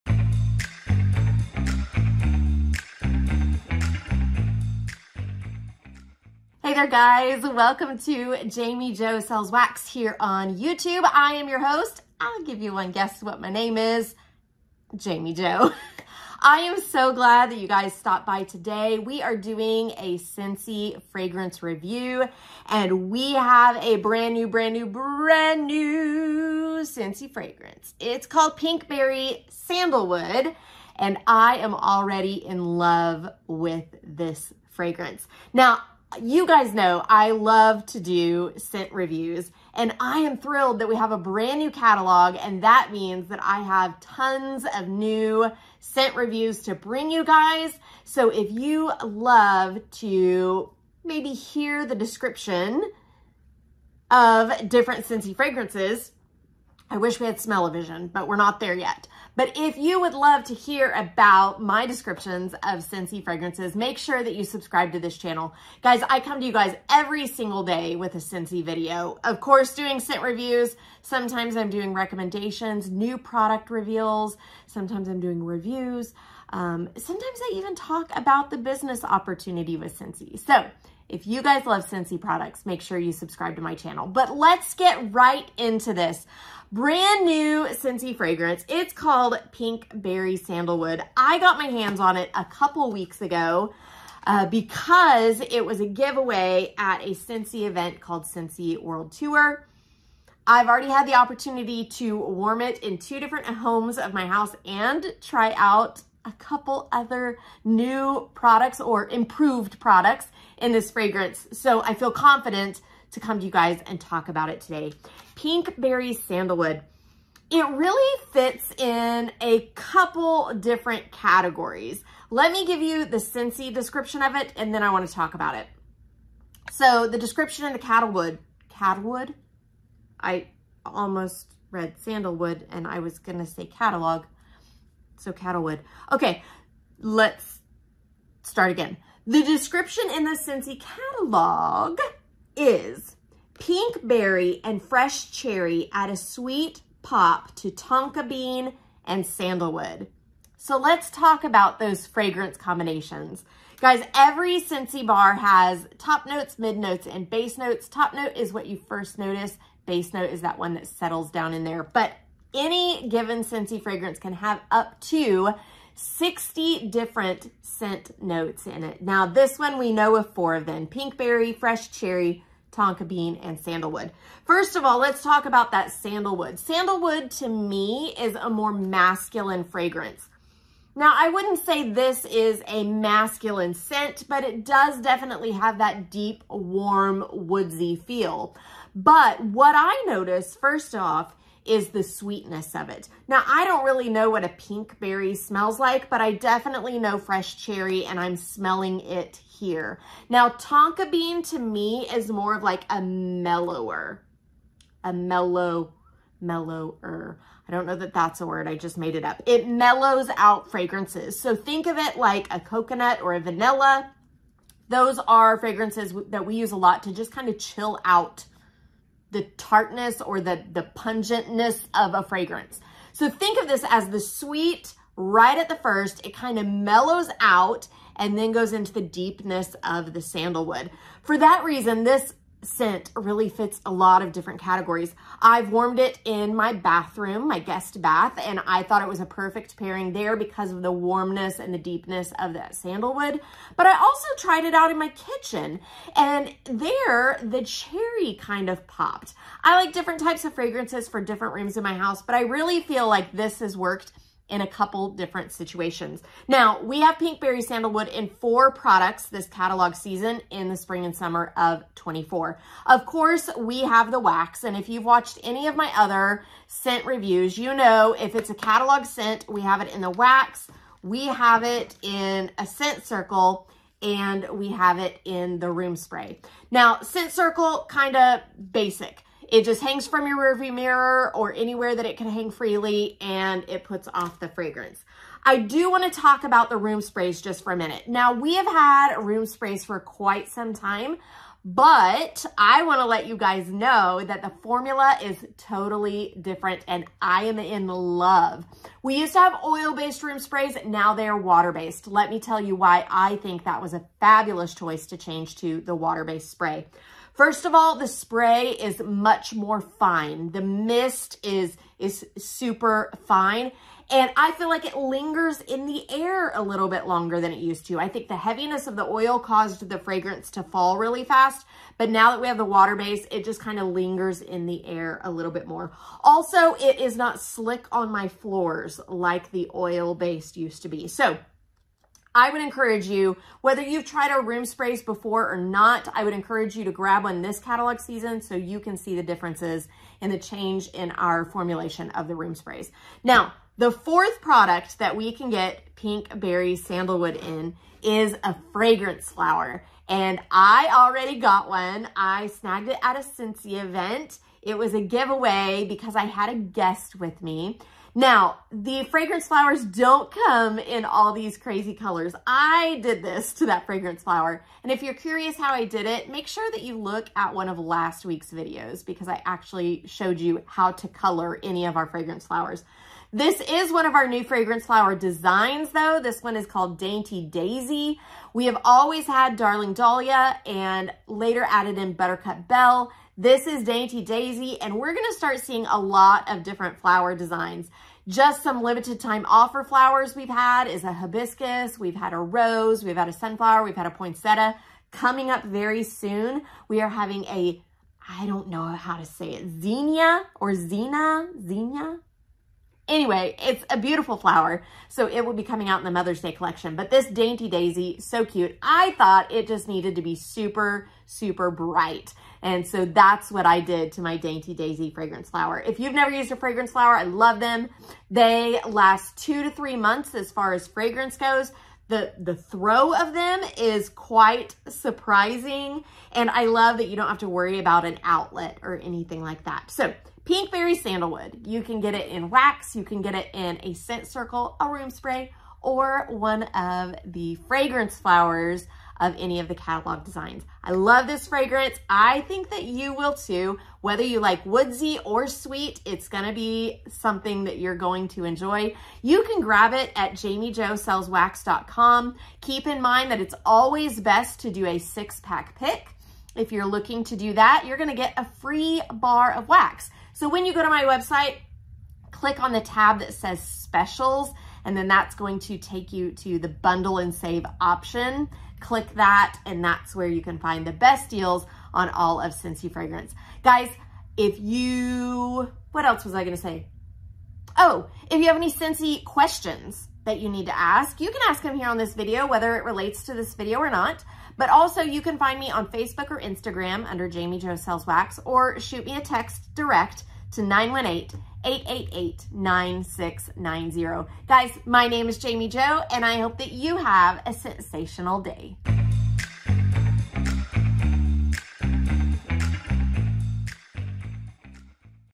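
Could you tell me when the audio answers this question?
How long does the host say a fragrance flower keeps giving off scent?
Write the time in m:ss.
6:59.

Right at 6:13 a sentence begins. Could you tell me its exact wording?
This is one of our new fragrance flower designs though.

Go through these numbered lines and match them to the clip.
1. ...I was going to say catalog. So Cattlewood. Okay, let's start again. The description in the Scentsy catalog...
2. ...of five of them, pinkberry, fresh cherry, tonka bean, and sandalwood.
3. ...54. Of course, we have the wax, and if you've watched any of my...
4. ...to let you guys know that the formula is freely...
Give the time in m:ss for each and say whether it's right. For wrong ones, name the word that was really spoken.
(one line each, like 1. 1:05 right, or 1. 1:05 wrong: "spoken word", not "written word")
1. 2:12 right
2. 2:50 wrong: "four", not "five"
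3. 4:21 wrong: "24", not "54"
4. 4:53 wrong: "totally", not "freely".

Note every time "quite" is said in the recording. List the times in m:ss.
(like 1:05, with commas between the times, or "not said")
4:49, 7:04.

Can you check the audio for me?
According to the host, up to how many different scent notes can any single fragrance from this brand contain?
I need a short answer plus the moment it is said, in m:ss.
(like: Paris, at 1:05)
60, at 2:45.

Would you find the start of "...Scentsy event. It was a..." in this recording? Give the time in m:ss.
5:53.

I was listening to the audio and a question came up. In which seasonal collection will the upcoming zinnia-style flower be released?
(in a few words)
Mother's Day collection.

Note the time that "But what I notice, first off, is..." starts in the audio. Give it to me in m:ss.
3:08.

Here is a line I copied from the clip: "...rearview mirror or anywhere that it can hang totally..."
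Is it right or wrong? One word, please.
wrong.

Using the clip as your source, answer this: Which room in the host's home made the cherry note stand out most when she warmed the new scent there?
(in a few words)
kitchen.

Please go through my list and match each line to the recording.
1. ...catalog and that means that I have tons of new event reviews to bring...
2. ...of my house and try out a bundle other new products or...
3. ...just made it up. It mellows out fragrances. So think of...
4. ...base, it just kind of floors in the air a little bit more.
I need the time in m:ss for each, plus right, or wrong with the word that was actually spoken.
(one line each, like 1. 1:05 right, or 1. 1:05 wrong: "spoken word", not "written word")
1. 0:41 wrong: "scent", not "event"
2. 1:43 wrong: "couple", not "bundle"
3. 3:28 right
4. 5:22 wrong: "lingers", not "floors".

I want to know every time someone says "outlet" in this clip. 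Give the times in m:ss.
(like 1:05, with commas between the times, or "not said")
7:08.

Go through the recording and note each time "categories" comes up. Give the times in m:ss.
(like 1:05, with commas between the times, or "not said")
2:01, 3:54.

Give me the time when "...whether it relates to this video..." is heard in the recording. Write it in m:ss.
8:02.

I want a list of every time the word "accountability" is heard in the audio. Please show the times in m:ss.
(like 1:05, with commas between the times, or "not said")
not said.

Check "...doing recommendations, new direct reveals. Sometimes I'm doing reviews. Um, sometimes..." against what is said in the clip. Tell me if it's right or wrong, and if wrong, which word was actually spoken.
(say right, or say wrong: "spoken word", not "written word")
wrong: "product", not "direct".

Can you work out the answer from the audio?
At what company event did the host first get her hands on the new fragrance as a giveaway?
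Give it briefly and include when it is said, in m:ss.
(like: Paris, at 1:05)
Scentsy World Tour, at 1:38.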